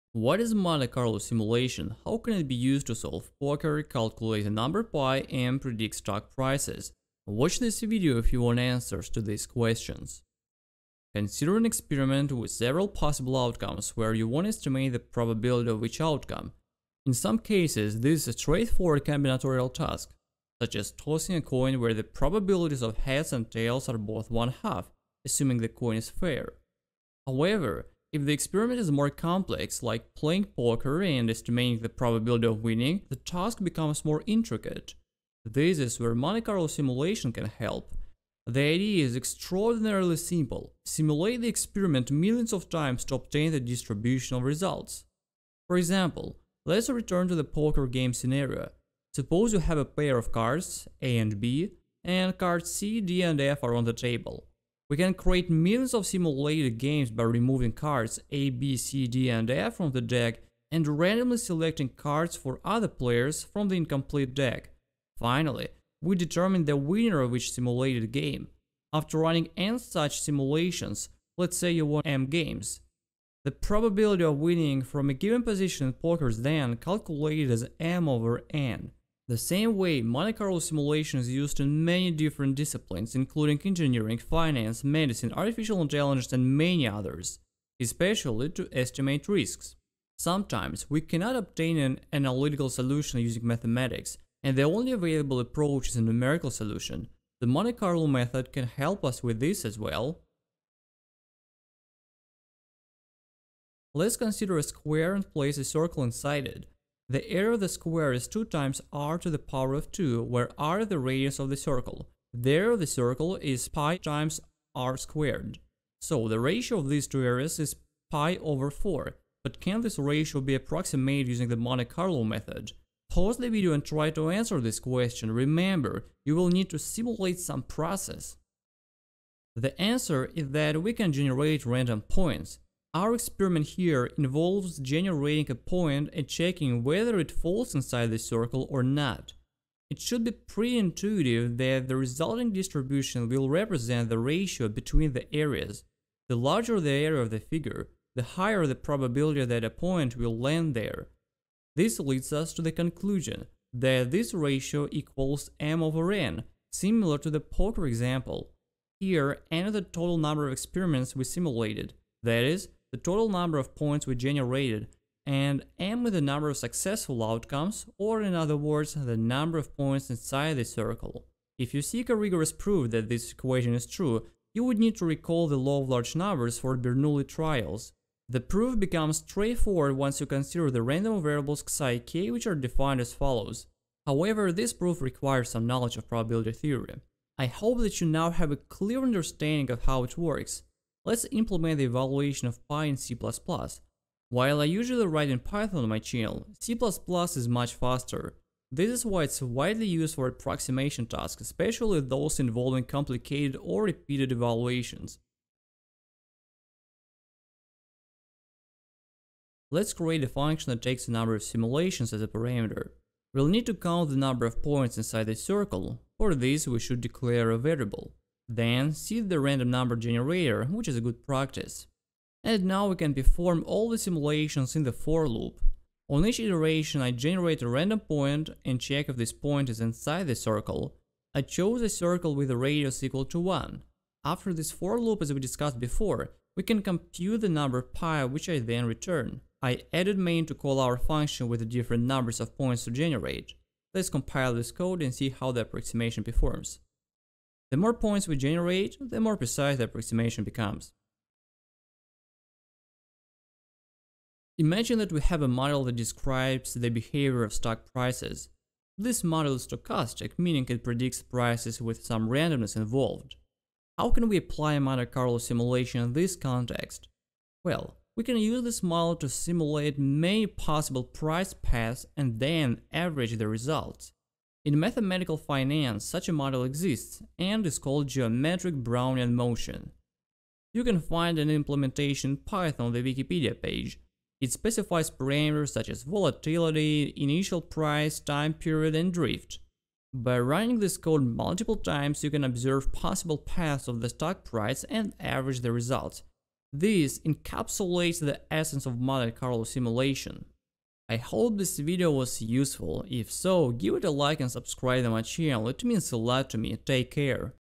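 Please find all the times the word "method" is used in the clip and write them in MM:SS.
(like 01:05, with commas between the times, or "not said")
01:38, 02:02.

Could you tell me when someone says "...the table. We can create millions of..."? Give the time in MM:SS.
00:53.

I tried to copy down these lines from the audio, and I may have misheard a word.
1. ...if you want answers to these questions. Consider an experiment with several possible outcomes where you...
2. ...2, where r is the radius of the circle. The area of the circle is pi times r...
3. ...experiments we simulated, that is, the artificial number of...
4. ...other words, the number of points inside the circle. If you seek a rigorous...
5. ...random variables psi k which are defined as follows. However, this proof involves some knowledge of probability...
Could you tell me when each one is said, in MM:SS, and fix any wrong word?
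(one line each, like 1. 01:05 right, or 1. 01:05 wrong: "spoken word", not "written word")
1. 00:08 right
2. 01:49 right
3. 02:40 wrong: "total", not "artificial"
4. 02:48 right
5. 03:00 wrong: "requires", not "involves".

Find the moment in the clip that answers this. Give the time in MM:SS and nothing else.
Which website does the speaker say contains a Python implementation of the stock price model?
04:43.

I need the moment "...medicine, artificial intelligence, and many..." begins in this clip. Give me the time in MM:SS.
01:24.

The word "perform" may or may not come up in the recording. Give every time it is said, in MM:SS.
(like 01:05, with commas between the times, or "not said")
03:43, 04:06.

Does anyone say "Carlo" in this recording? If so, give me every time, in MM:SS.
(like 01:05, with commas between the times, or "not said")
00:00, 00:36, 01:20, 01:37, 02:01, 04:25, 04:59.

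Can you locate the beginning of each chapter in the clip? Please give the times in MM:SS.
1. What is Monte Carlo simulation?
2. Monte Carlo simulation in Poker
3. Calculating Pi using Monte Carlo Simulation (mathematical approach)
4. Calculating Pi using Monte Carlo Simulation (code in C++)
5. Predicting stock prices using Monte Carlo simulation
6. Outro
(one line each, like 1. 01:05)
1. 00:10
2. 00:48
3. 01:40
4. 03:15
5. 04:12
6. 05:00.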